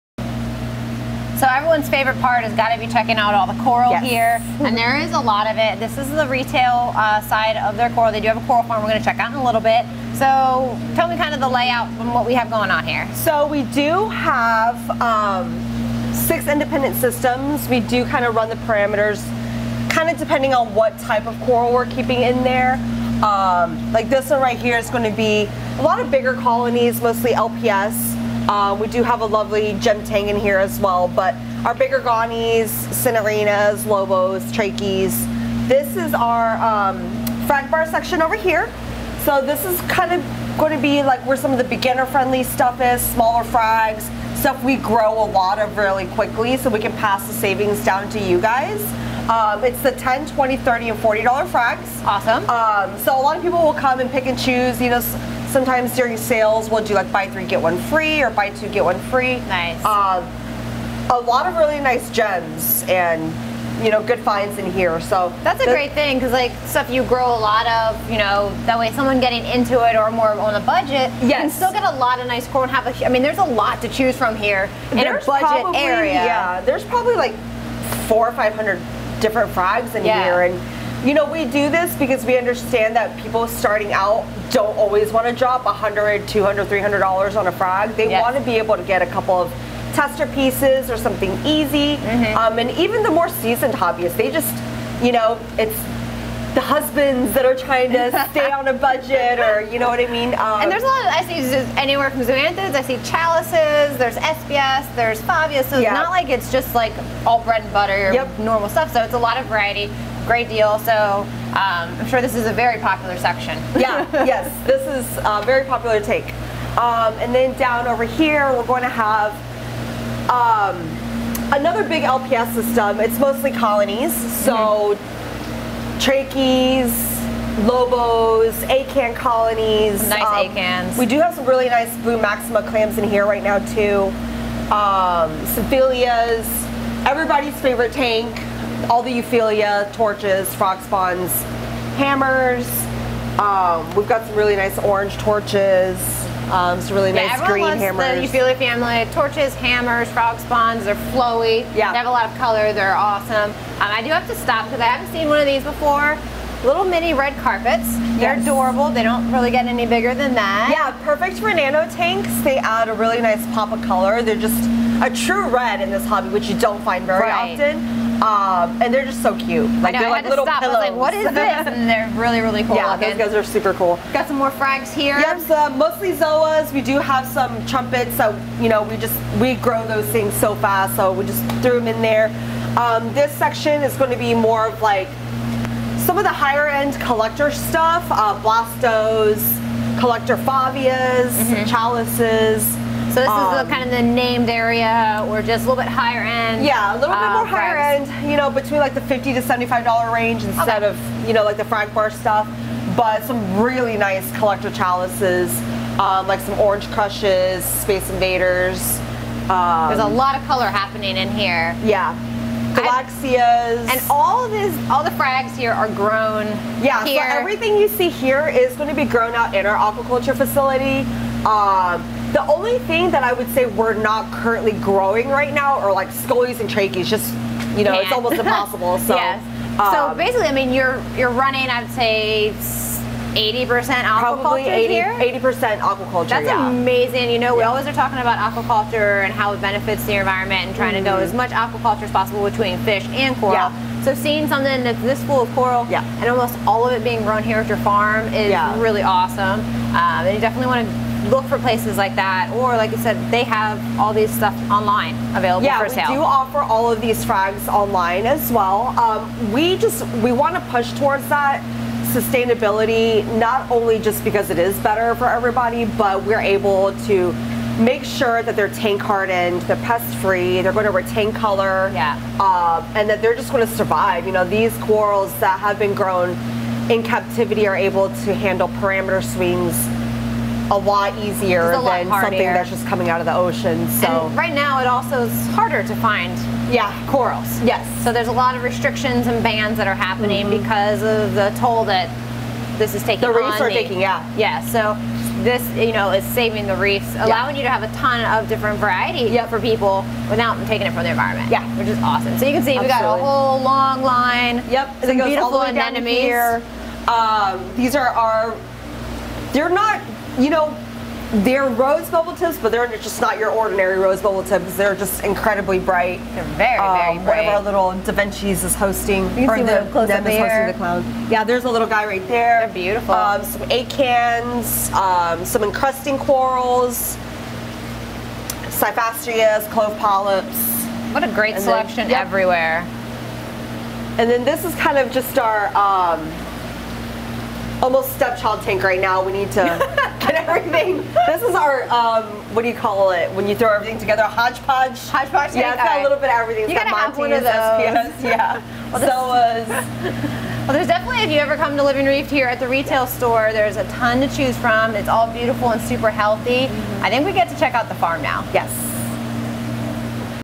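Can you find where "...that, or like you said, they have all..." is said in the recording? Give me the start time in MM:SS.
04:12.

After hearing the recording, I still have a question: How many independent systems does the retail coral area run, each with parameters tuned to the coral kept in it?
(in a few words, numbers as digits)
6.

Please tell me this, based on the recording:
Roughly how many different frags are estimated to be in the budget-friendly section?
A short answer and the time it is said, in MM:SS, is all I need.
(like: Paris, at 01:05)
400 or 500, at 01:18.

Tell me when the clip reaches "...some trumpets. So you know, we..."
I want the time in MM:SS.
02:57.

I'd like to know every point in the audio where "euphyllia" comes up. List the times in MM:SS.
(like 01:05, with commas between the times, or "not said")
02:19, 02:28.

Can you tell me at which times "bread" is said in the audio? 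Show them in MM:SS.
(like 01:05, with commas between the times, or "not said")
01:47.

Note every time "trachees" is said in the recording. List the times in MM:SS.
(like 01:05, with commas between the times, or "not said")
00:34, 02:06, 03:46.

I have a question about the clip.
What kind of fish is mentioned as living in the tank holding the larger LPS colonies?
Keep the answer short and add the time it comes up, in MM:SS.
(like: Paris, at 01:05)
Gem tang, at 00:29.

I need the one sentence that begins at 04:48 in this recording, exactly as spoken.
So there's a lot of restrictions and bans that are happening mm -hmm.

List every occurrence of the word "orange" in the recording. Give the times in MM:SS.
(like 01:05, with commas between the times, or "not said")
02:24, 03:26.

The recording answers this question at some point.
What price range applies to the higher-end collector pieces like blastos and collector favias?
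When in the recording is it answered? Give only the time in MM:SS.
03:19.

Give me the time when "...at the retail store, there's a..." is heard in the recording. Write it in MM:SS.
05:52.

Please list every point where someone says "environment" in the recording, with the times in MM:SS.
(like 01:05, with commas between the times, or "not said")
04:00, 05:01.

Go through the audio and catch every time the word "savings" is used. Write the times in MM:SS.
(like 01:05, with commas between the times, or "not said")
00:47, 04:56.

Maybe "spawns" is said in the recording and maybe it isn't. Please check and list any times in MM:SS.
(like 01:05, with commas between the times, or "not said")
02:20, 02:30.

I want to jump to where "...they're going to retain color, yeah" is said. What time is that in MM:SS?
04:30.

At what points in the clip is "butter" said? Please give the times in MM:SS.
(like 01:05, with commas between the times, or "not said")
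01:47.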